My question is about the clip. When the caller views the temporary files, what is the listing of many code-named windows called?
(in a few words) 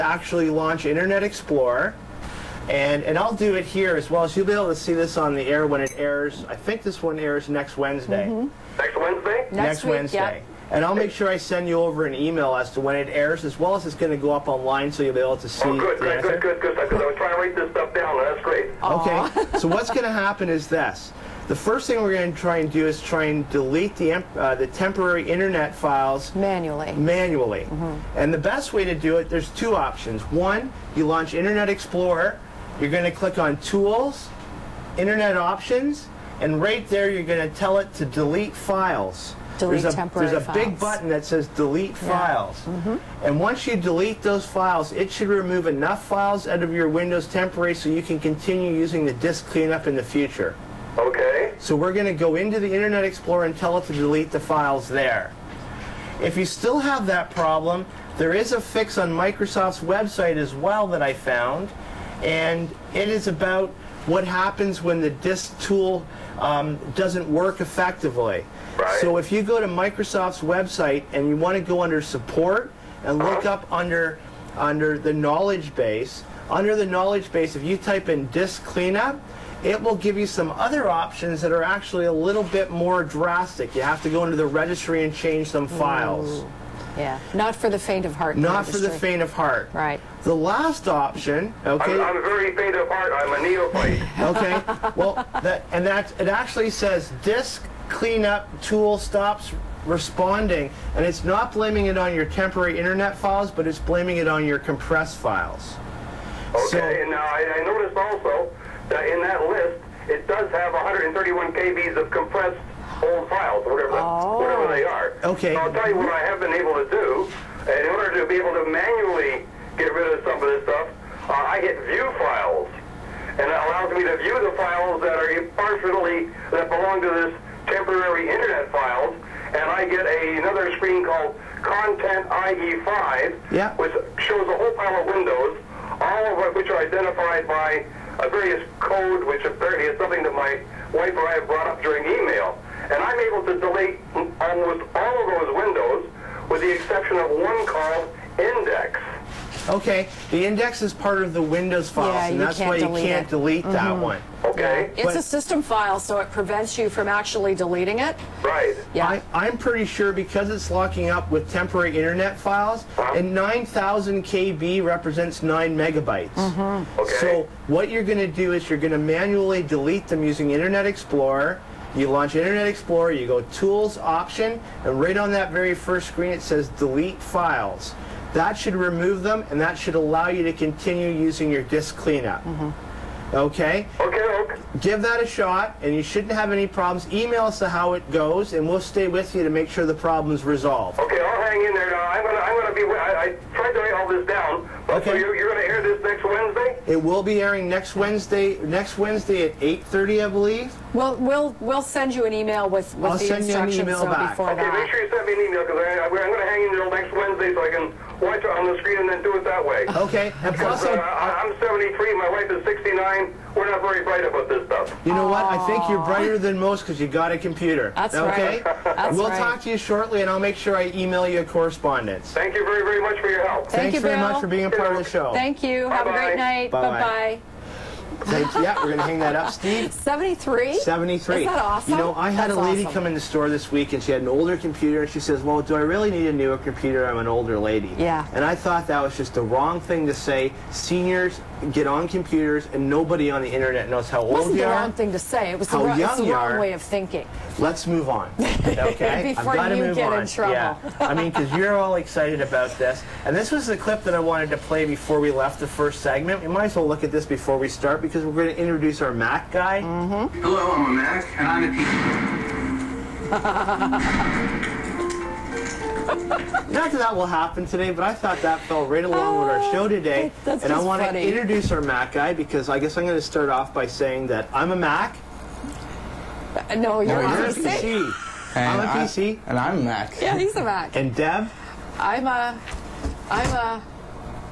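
Content IE5.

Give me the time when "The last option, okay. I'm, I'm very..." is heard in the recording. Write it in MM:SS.
01:30.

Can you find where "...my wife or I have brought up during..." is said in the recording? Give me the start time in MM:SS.
02:20.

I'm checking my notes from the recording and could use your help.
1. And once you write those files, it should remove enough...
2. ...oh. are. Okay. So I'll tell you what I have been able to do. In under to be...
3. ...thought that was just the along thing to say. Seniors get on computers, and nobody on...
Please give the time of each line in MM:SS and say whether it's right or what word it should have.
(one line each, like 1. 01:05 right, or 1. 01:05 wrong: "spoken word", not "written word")
1. 00:43 wrong: "delete", not "write"
2. 01:54 wrong: "order", not "under"
3. 03:58 wrong: "wrong", not "along".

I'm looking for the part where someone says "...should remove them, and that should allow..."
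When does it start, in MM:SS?
02:58.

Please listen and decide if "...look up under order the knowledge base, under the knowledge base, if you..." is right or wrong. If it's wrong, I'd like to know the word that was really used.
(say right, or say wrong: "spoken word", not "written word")
wrong: "under", not "order".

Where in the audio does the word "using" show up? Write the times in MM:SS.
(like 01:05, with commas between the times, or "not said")
00:48, 02:50, 03:01.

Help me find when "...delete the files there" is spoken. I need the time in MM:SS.
00:53.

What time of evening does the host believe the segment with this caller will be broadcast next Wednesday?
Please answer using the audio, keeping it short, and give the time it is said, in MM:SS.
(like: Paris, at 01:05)
8:30, at 03:19.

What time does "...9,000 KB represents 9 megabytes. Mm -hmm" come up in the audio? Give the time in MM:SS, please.
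02:43.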